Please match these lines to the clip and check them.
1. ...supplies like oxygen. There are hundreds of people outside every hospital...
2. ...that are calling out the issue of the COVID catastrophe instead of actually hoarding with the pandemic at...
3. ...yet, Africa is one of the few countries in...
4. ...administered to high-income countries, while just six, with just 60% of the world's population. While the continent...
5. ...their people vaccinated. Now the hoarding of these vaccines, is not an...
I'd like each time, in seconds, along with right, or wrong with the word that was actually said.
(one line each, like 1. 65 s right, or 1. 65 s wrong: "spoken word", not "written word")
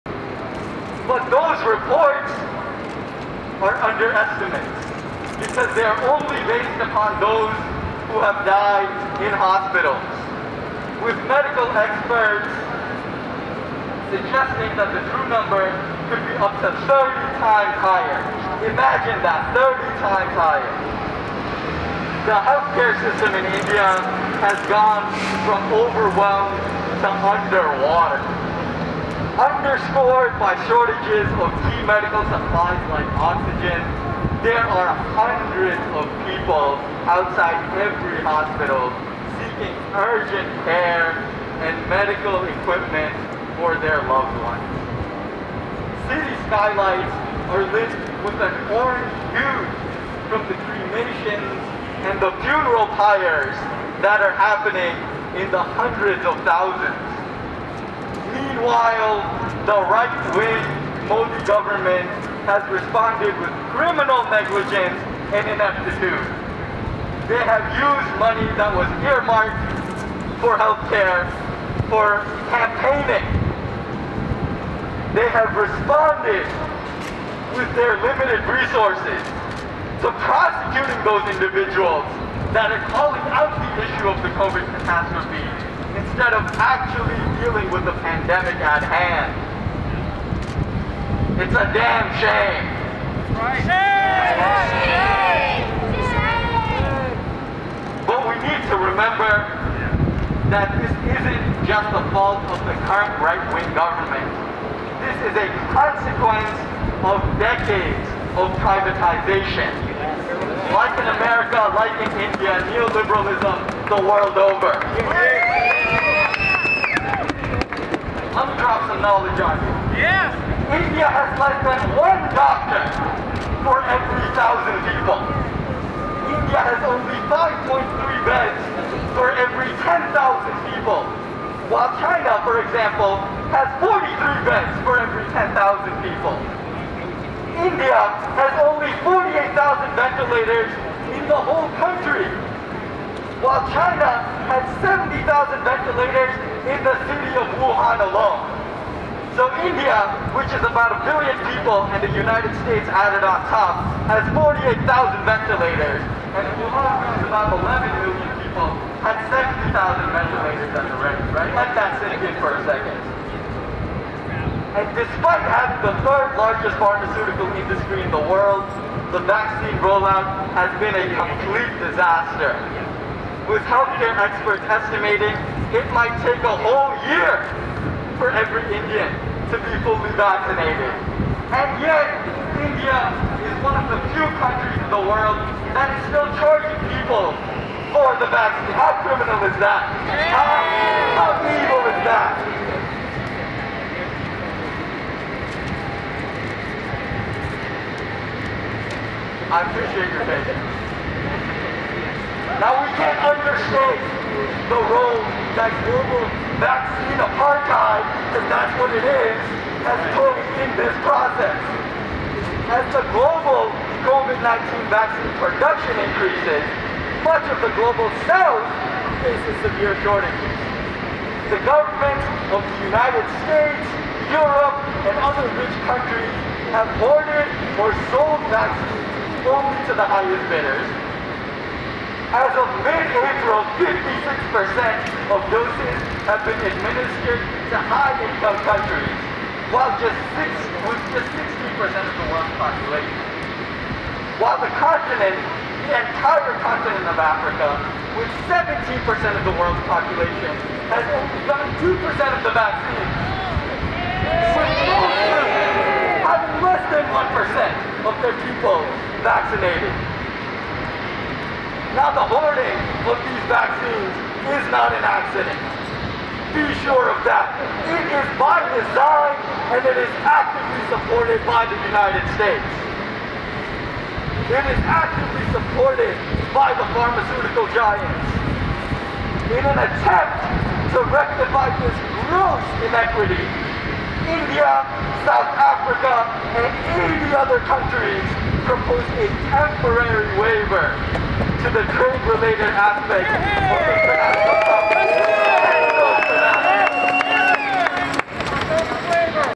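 1. 32 s right
2. 82 s wrong: "dealing", not "hoarding"
3. 181 s wrong: "India", not "Africa"
4. 236 s right
5. 258 s right.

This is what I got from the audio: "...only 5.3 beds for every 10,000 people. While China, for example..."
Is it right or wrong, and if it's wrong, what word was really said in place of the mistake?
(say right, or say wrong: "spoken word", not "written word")
right.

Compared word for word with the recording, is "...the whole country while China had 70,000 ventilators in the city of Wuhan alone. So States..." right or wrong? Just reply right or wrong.
wrong.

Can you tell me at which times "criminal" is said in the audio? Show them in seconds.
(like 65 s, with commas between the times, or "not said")
63 s, 189 s.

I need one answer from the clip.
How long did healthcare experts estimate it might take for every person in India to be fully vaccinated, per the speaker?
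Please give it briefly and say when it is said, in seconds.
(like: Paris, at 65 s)
a whole year, at 176 s.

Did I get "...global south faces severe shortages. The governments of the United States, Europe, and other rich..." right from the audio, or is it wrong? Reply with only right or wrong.
right.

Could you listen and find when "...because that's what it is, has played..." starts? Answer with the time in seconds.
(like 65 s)
208 s.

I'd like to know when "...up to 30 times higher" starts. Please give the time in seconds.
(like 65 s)
16 s.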